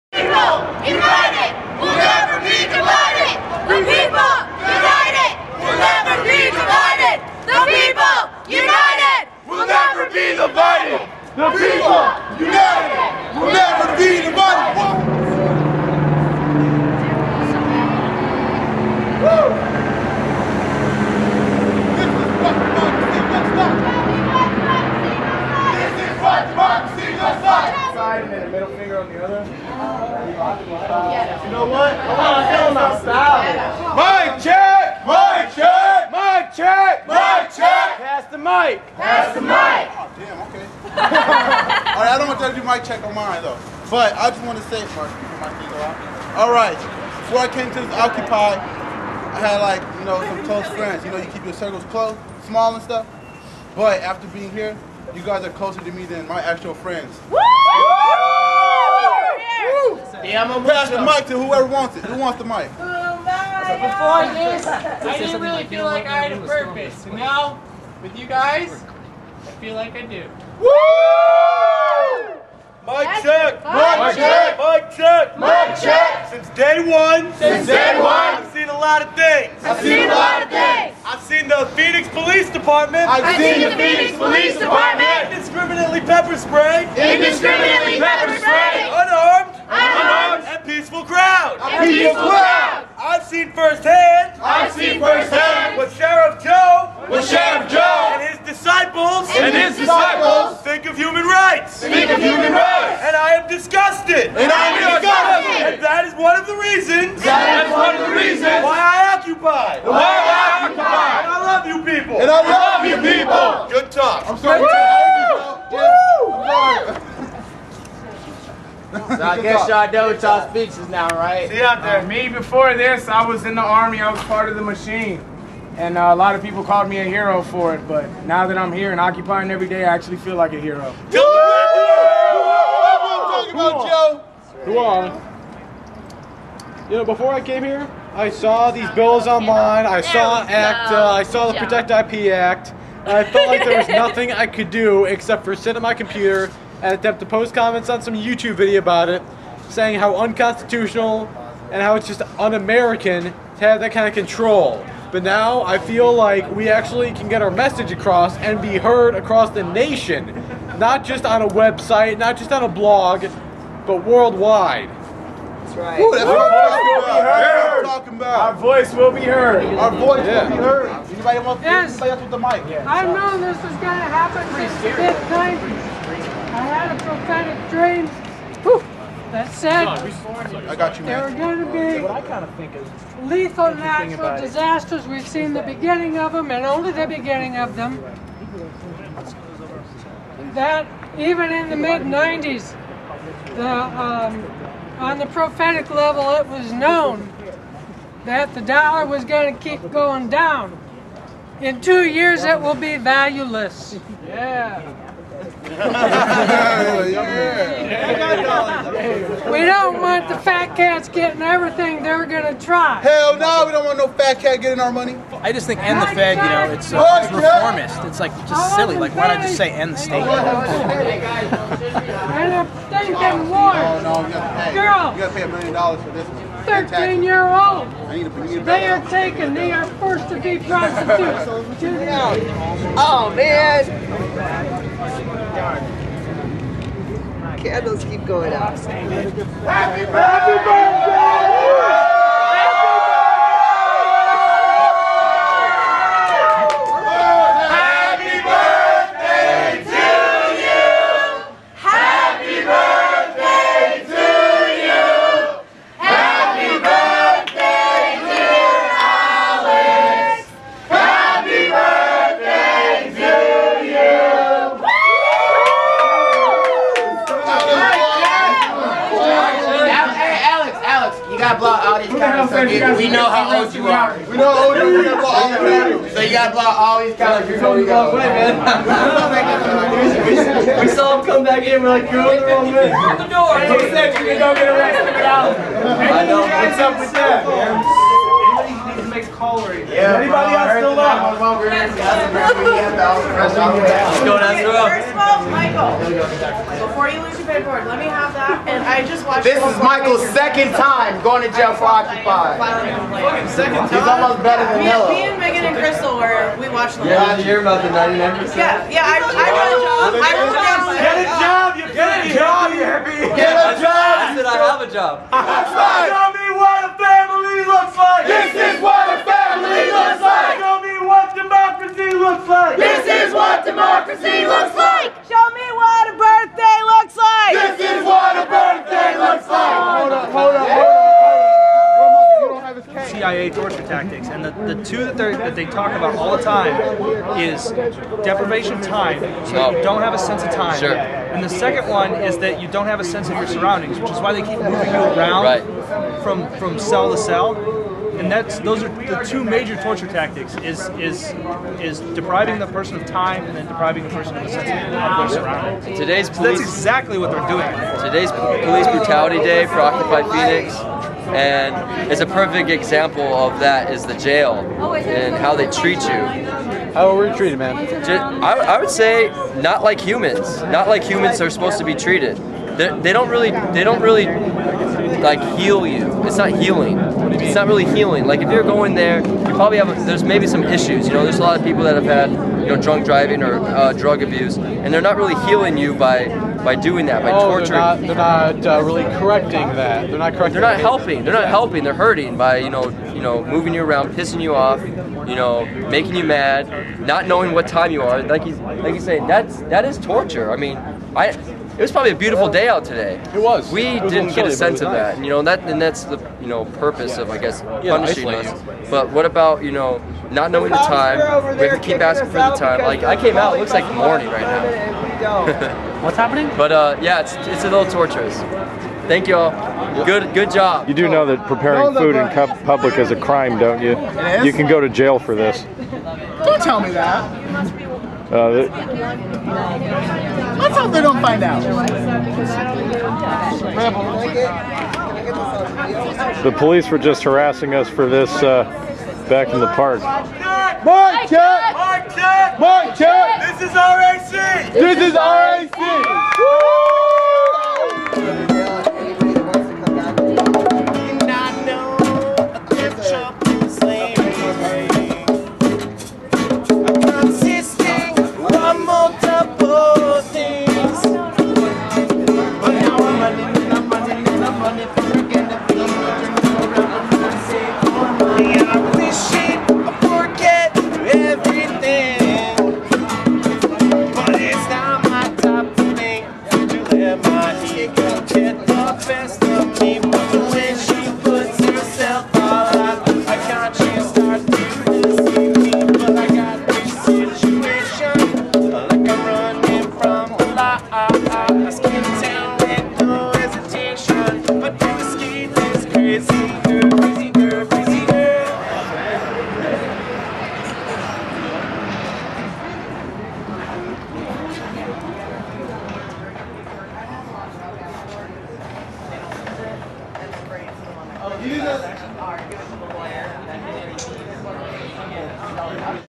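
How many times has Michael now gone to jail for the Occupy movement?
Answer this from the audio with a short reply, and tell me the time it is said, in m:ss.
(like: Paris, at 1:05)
2, at 5:00.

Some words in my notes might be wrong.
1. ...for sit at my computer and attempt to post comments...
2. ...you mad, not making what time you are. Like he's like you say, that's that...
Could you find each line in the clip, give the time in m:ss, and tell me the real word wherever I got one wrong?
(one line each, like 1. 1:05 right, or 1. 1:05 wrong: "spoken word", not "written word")
1. 2:25 right
2. 6:36 wrong: "knowing", not "making".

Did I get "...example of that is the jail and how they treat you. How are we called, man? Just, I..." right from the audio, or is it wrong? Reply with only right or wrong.
wrong.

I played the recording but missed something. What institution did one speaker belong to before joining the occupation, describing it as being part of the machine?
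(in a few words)
The army.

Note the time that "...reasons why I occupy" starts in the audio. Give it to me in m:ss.
1:48.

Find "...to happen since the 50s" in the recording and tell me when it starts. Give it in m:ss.
2:53.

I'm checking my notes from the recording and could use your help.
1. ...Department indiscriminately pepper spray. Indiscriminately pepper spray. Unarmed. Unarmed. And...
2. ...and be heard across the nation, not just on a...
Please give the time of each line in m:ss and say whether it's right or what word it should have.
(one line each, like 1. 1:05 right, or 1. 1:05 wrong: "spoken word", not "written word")
1. 1:24 right
2. 2:38 right.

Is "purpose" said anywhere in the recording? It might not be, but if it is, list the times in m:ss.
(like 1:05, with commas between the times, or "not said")
1:06, 6:46.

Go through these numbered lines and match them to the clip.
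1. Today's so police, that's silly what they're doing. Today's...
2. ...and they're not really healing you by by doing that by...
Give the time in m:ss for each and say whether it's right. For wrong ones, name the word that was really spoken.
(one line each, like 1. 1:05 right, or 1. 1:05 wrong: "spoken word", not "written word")
1. 5:55 wrong: "exactly", not "silly"
2. 6:24 right.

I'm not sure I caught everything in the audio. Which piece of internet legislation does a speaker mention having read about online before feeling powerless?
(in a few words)
Protect IP Act.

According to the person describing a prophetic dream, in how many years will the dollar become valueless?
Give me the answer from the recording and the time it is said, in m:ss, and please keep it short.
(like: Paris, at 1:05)
2, at 3:21.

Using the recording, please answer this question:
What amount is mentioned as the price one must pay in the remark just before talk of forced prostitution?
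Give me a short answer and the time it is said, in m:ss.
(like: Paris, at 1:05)
A million dollars, at 3:45.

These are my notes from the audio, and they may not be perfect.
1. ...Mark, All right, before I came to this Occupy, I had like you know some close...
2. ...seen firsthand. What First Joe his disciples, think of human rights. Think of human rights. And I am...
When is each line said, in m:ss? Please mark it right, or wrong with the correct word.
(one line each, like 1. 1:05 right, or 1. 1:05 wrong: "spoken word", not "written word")
1. 0:44 right
2. 1:34 wrong: "Sheriff", not "First".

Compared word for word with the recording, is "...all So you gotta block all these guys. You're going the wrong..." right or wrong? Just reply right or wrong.
right.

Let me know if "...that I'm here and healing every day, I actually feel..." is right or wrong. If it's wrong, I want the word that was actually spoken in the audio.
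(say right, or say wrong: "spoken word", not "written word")
wrong: "occupying", not "healing".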